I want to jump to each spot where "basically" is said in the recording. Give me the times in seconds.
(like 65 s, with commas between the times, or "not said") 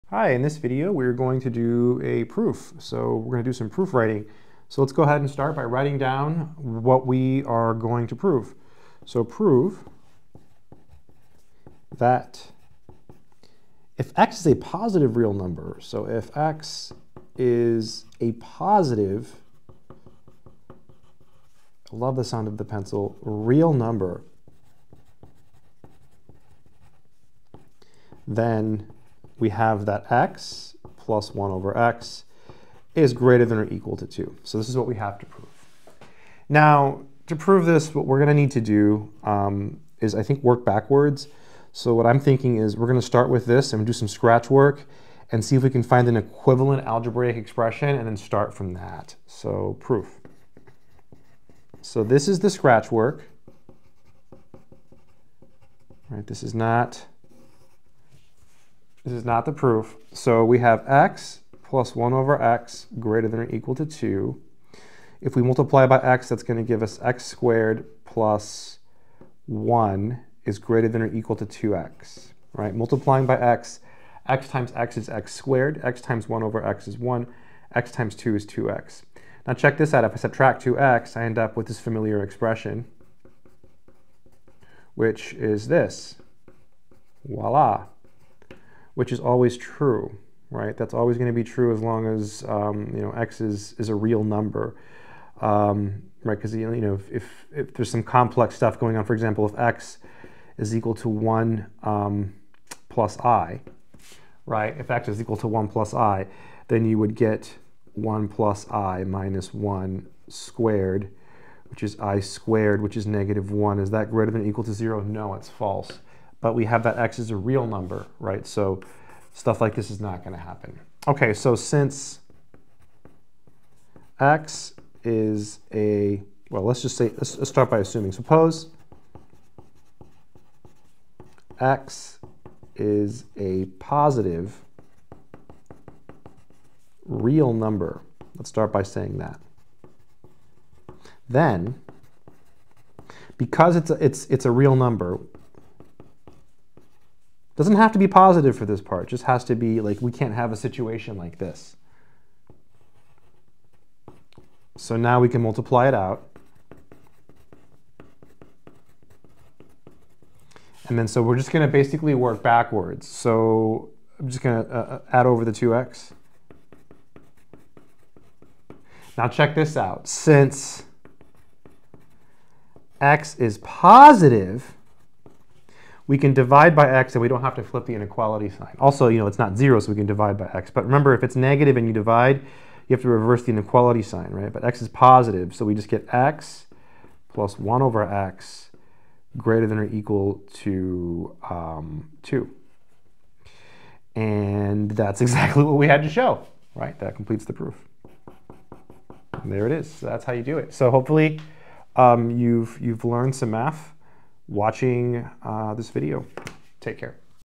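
161 s.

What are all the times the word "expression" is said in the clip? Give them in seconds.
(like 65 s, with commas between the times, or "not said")
47 s, 82 s.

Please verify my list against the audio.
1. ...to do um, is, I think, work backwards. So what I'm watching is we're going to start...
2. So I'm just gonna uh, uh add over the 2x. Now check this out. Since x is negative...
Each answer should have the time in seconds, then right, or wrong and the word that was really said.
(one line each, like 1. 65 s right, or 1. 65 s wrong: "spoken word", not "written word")
1. 38 s wrong: "thinking", not "watching"
2. 163 s wrong: "positive", not "negative".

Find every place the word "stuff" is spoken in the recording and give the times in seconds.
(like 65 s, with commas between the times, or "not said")
98 s, 119 s.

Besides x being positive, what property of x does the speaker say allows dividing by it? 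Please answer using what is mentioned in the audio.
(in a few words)
it's not zero.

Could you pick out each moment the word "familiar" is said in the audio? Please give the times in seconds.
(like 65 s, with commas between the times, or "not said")
81 s.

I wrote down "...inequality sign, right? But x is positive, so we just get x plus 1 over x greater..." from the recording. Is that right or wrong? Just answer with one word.
right.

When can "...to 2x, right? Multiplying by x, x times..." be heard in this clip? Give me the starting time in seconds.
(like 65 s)
71 s.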